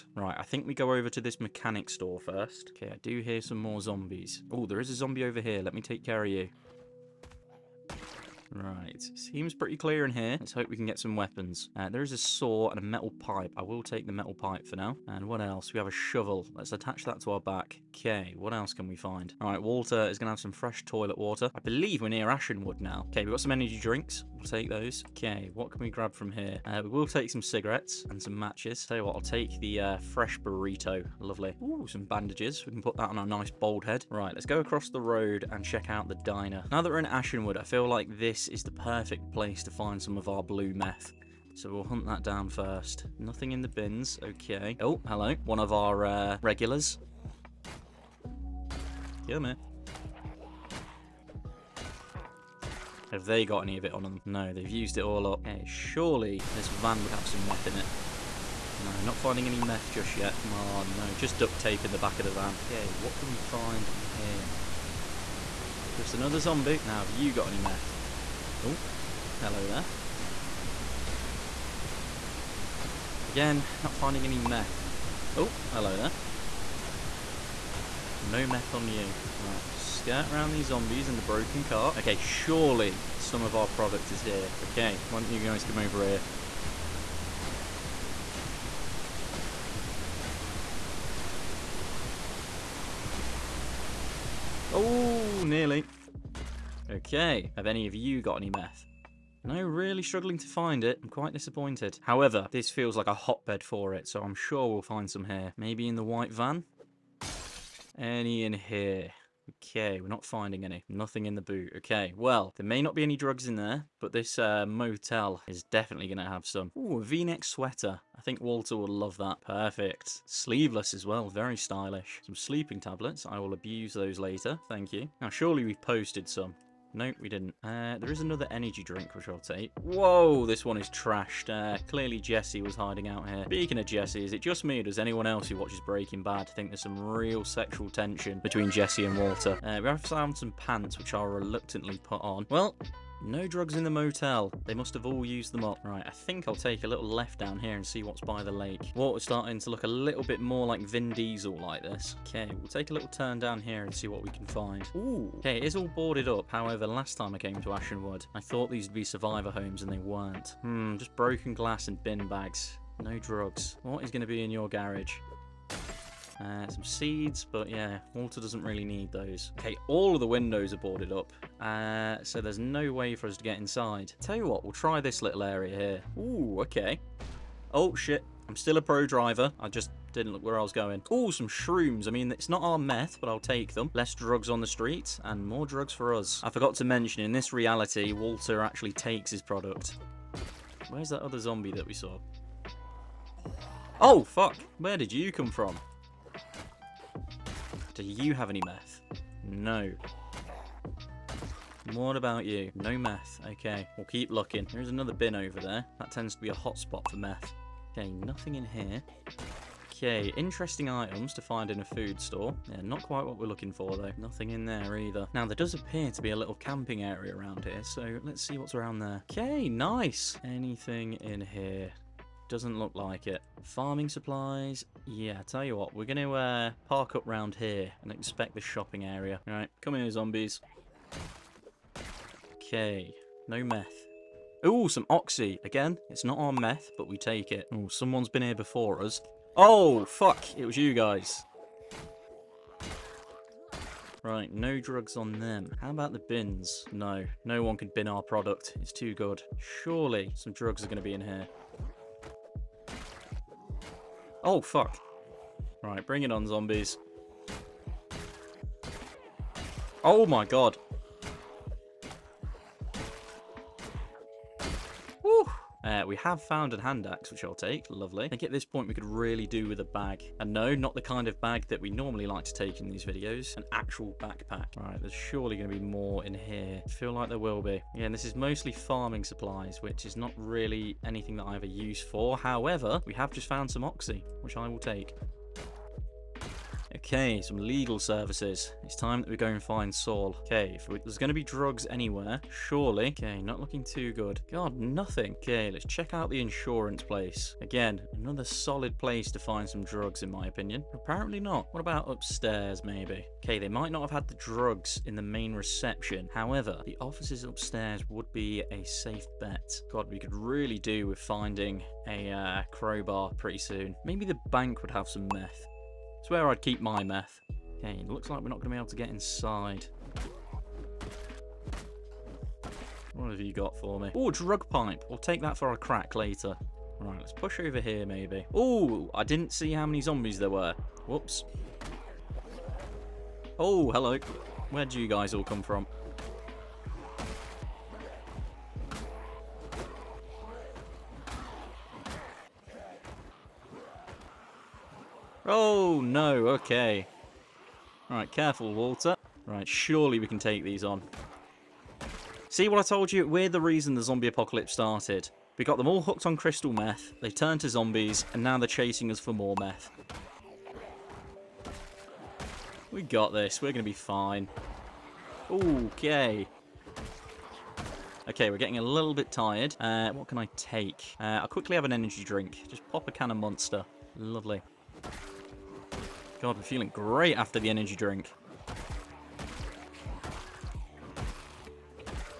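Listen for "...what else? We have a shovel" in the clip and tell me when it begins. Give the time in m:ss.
0:15.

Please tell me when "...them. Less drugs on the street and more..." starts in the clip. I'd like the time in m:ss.
3:03.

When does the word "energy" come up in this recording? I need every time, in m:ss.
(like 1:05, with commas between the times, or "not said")
0:23, 2:08, 6:11, 6:17.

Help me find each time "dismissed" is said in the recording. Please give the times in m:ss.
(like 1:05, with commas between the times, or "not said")
not said.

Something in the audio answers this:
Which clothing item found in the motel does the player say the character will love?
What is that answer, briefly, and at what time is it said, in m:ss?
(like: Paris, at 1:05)
v-neck sweater, at 1:57.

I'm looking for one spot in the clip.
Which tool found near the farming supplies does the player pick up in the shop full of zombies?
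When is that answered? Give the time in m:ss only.
4:26.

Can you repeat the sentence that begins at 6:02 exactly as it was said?
We got this, we're going to be fine.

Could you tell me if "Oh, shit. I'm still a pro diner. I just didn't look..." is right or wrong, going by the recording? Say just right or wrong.
wrong.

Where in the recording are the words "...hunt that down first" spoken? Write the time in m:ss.
0:41.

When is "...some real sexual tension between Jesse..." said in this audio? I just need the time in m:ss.
2:16.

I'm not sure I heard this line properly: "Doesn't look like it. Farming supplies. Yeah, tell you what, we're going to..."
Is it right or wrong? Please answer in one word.
right.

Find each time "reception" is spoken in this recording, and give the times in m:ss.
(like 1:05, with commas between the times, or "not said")
5:05.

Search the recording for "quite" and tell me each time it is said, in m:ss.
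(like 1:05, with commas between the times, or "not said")
1:41, 3:33.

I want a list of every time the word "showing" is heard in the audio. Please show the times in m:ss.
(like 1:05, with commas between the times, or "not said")
not said.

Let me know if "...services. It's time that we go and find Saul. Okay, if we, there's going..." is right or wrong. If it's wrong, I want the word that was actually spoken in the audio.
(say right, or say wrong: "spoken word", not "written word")
right.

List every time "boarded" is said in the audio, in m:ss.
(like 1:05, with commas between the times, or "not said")
2:35, 2:50.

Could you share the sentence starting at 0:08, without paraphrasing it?
Right, seems pretty clear in here.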